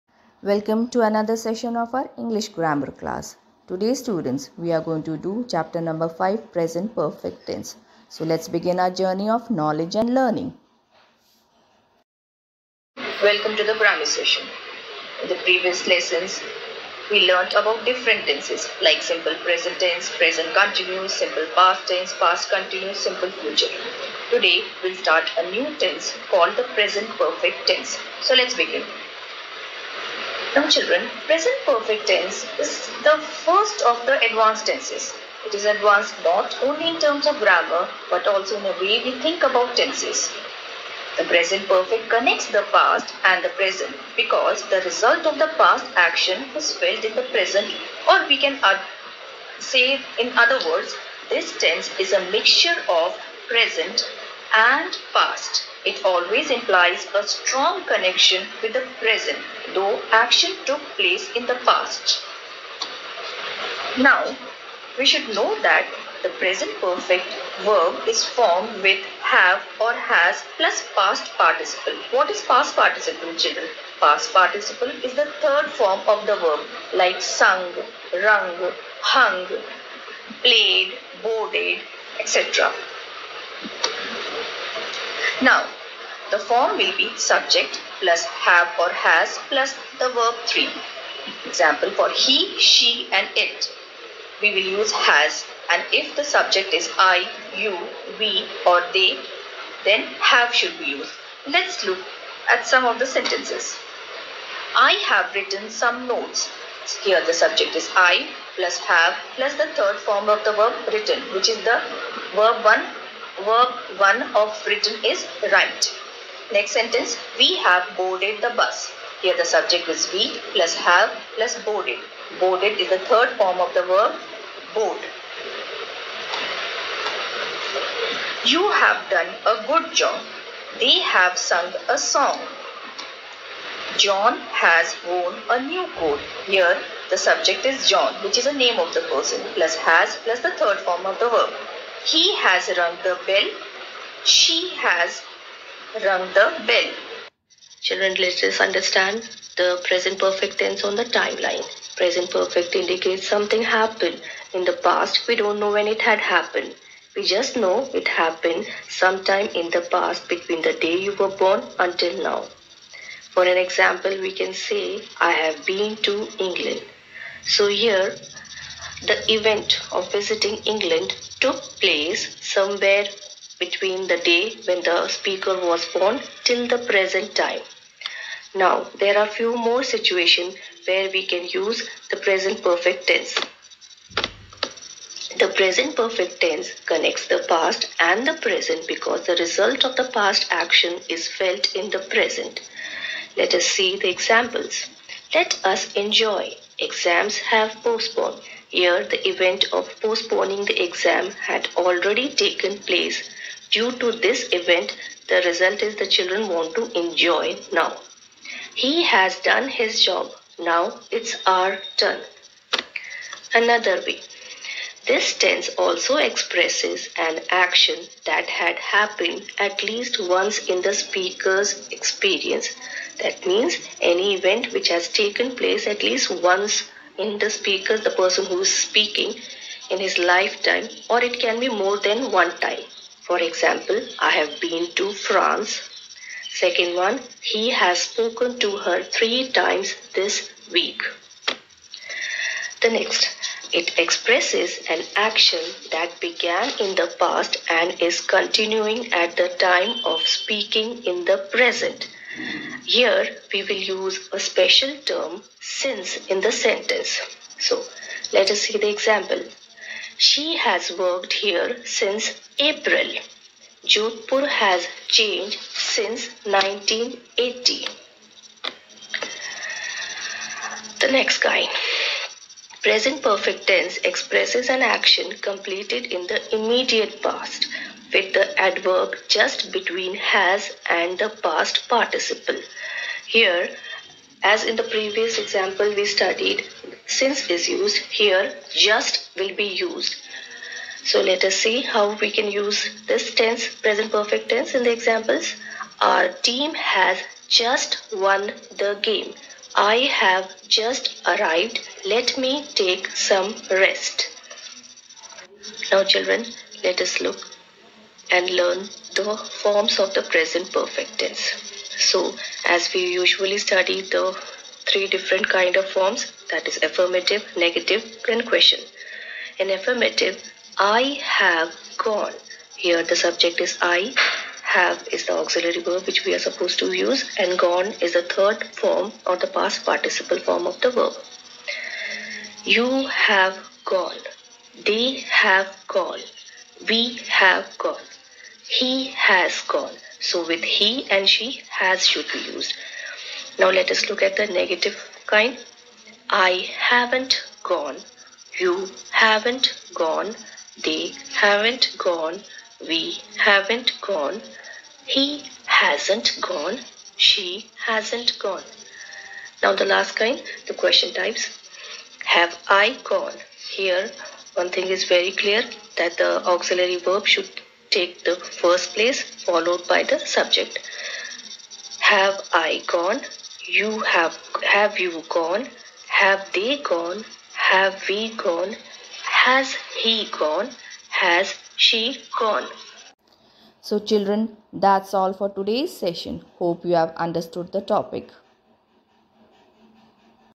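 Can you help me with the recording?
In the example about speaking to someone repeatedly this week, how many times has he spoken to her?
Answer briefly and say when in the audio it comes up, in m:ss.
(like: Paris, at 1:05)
3, at 3:59.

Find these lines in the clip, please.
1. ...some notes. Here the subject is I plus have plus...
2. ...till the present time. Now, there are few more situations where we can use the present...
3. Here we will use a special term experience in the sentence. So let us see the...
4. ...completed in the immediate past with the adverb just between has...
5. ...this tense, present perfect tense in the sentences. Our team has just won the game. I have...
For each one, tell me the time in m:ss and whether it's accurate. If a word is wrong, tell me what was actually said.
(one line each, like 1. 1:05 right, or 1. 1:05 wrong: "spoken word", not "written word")
1. 1:45 right
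2. 2:56 right
3. 4:12 wrong: "since", not "experience"
4. 4:35 right
5. 4:53 wrong: "examples", not "sentences".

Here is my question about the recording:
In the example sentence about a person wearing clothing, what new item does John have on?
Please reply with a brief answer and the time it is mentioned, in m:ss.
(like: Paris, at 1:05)
a new coat, at 2:15.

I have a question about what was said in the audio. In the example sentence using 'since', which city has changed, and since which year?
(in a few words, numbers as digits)
Jodhpur, 1980.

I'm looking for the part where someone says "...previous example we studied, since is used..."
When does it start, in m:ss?
4:44.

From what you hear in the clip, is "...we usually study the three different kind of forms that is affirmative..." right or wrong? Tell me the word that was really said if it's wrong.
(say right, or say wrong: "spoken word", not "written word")
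right.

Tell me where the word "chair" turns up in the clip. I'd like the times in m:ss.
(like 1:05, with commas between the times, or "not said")
not said.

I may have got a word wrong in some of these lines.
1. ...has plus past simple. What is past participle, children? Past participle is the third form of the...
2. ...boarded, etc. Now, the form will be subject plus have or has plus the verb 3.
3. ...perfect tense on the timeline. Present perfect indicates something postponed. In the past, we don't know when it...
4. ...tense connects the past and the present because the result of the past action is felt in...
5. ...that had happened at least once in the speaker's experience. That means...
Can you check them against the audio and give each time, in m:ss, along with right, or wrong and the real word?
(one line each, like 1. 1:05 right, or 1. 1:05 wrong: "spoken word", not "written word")
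1. 1:09 wrong: "participle", not "simple"
2. 1:21 right
3. 2:30 wrong: "happened", not "postponed"
4. 3:06 right
5. 3:38 right.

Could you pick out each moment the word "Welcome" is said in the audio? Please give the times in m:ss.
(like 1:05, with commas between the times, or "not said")
0:00, 0:13.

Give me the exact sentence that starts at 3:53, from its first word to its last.
For example, I have been to France.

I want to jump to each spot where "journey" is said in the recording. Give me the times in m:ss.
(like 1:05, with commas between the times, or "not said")
0:08.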